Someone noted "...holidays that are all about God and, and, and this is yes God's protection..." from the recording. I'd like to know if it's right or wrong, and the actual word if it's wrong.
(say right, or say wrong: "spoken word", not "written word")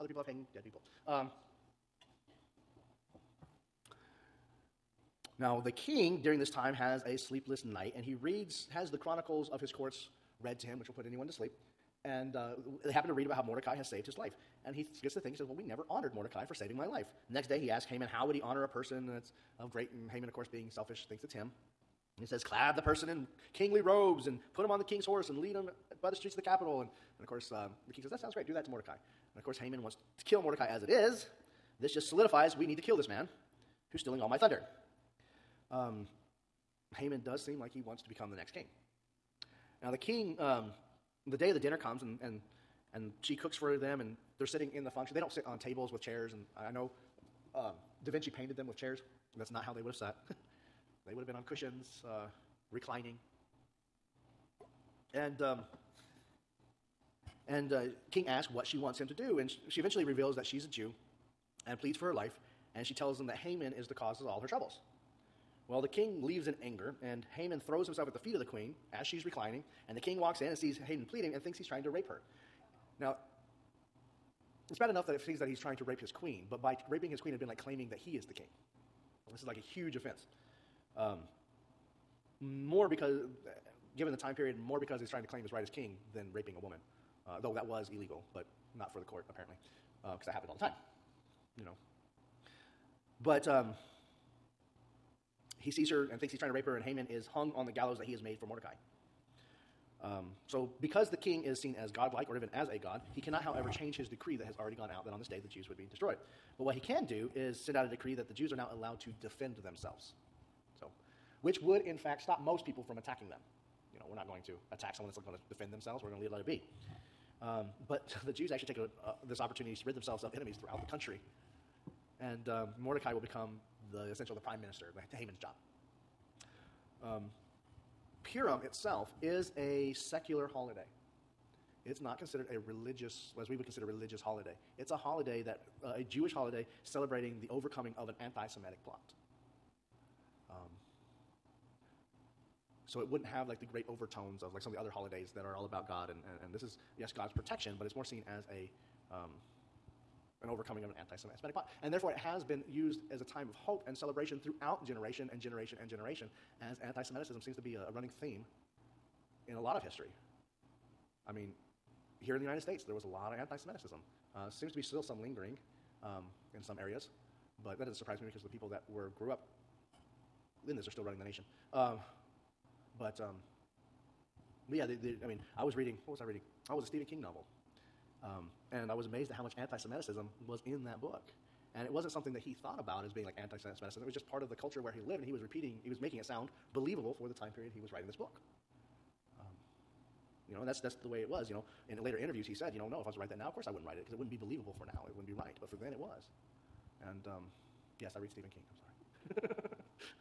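right.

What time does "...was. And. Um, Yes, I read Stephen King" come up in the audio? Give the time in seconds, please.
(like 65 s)
195 s.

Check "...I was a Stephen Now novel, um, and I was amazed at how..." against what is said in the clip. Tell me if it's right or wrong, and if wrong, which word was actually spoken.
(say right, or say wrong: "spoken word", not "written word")
wrong: "King", not "Now".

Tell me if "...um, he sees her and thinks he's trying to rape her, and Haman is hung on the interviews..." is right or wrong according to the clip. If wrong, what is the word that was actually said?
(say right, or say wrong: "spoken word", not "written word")
wrong: "gallows", not "interviews".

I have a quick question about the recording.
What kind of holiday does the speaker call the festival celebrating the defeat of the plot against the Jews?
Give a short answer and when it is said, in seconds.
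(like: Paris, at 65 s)
Secular, at 129 s.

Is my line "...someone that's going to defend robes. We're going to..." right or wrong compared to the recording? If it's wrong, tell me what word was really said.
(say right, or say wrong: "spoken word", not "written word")
wrong: "themselves", not "robes".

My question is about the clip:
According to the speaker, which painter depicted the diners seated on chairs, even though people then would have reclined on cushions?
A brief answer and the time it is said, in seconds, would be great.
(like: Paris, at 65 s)
Da Vinci, at 48 s.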